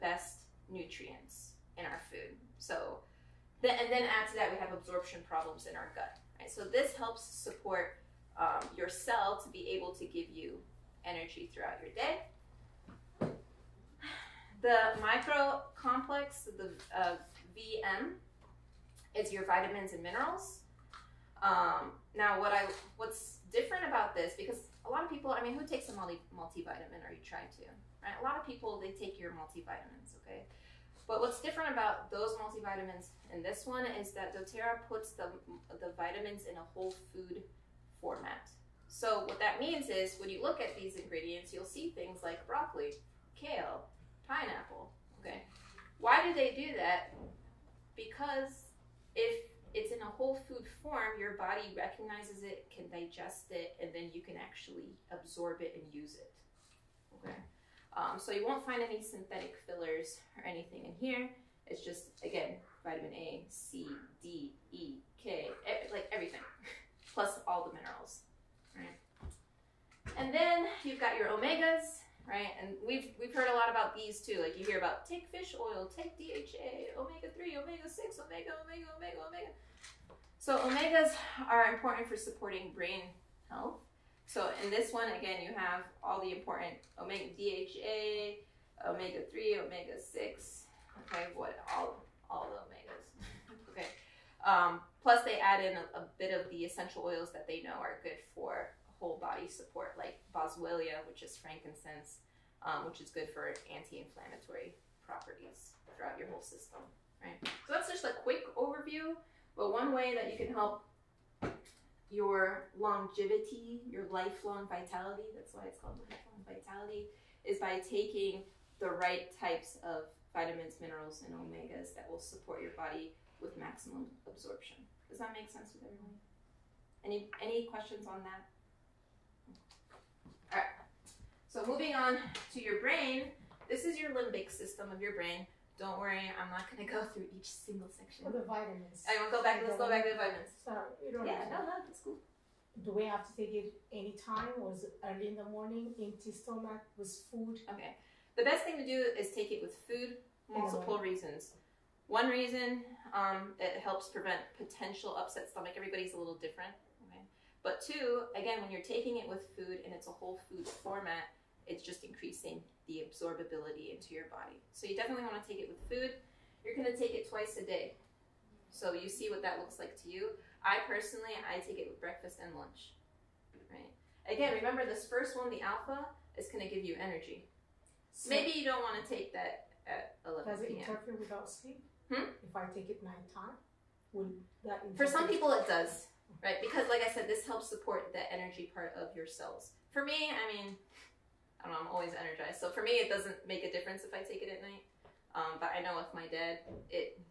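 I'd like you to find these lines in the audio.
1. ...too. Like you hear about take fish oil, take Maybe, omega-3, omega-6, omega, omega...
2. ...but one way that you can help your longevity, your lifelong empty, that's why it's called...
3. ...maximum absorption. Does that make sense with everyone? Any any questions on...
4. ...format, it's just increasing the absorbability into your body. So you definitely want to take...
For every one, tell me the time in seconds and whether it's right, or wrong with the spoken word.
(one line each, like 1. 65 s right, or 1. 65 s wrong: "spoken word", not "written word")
1. 74 s wrong: "DHA", not "Maybe"
2. 109 s wrong: "vitality", not "empty"
3. 123 s right
4. 160 s right.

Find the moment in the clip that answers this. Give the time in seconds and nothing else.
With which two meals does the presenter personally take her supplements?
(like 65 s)
172 s.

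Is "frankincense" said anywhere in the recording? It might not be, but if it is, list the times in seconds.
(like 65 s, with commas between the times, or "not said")
101 s.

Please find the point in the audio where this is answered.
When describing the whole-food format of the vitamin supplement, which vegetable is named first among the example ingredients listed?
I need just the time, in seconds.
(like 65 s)
42 s.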